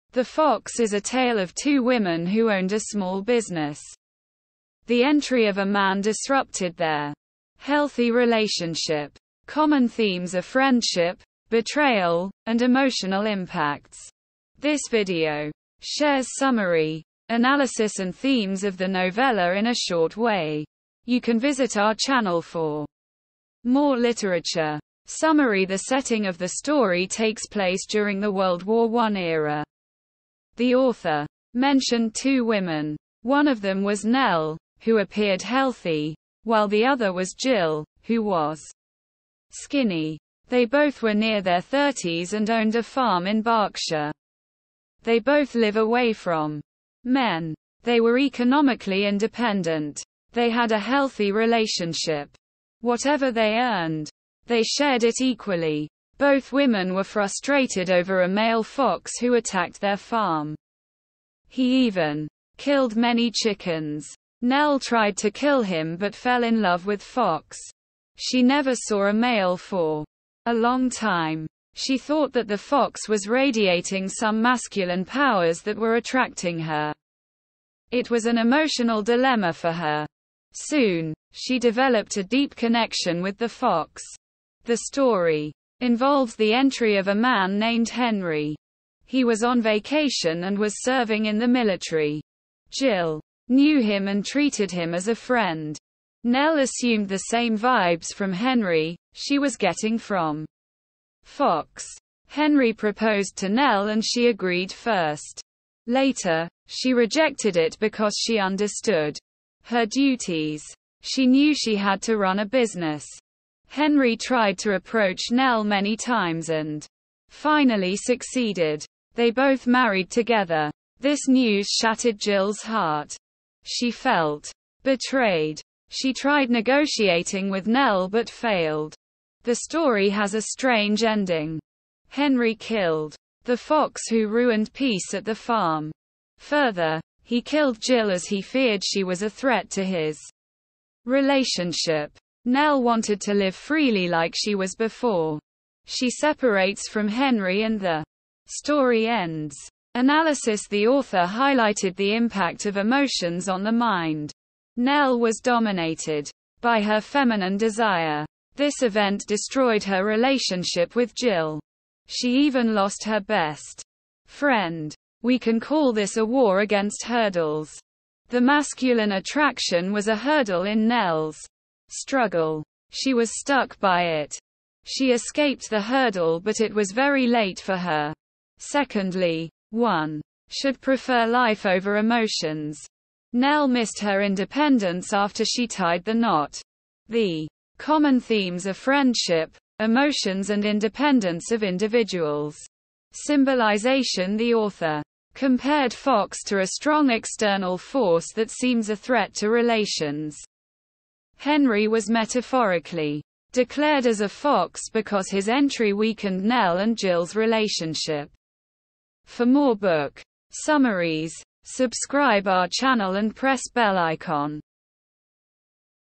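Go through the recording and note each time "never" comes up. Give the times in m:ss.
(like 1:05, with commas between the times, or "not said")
1:08.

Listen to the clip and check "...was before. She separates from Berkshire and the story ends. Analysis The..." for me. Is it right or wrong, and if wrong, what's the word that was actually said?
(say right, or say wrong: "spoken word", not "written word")
wrong: "Henry", not "Berkshire".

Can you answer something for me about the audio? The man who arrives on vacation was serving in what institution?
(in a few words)
The military.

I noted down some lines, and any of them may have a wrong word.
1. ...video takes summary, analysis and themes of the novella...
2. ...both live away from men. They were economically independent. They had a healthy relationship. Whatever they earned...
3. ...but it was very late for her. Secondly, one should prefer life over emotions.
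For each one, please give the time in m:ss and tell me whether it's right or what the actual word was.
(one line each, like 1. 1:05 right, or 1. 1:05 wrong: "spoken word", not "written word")
1. 0:14 wrong: "shares", not "takes"
2. 0:45 right
3. 2:56 right.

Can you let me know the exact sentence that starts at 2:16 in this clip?
Further, he killed Jill as he feared she was a threat to his relationship.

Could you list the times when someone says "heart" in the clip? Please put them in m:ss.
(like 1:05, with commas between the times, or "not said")
2:02.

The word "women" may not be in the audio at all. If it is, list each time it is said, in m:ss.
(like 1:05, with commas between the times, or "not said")
0:01, 0:32, 0:56.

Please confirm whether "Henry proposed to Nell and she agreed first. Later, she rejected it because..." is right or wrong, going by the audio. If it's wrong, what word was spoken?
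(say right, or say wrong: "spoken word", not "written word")
right.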